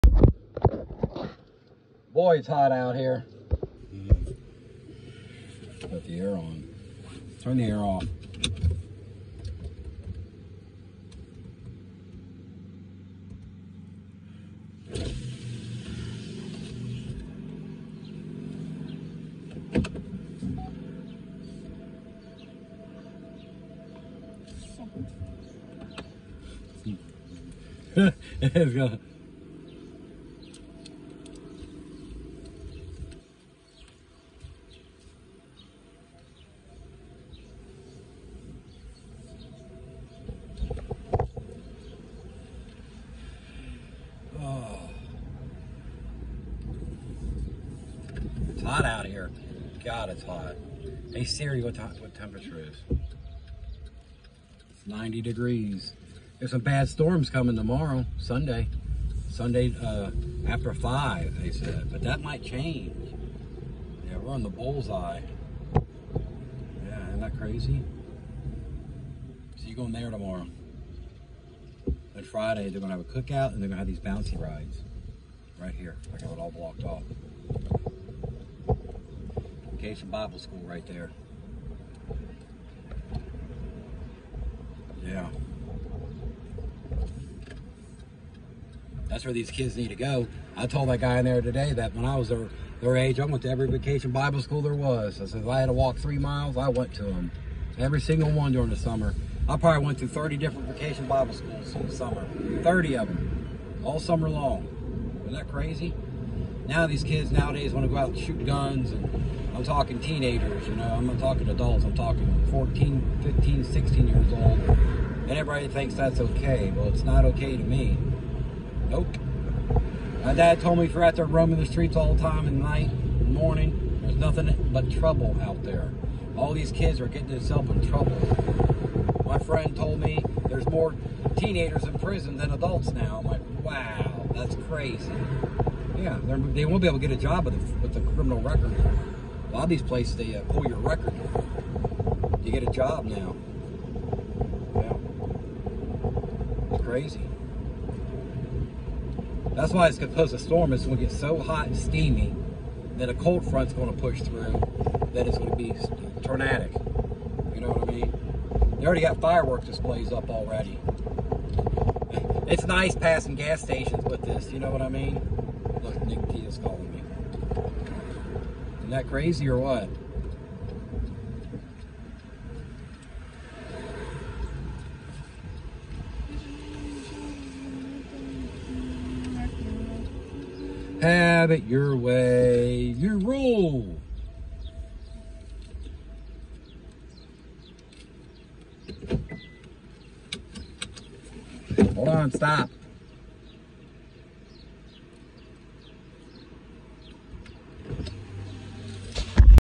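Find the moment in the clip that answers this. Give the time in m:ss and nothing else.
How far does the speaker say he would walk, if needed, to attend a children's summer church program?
1:35.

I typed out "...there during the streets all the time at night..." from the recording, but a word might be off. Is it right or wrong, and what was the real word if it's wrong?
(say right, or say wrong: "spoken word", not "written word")
wrong: "roaming", not "during".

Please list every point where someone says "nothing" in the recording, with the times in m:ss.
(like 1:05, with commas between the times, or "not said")
2:04.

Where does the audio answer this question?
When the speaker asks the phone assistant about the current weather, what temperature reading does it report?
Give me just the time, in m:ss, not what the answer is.
0:54.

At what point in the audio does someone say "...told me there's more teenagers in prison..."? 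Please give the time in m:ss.
2:09.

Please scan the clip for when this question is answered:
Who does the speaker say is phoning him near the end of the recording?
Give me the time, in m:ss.
2:46.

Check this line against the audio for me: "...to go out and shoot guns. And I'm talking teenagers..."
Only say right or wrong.
right.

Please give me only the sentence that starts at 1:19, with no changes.
Okay, some Bible school right there.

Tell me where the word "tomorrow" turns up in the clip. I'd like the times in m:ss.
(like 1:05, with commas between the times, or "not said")
0:57, 1:10.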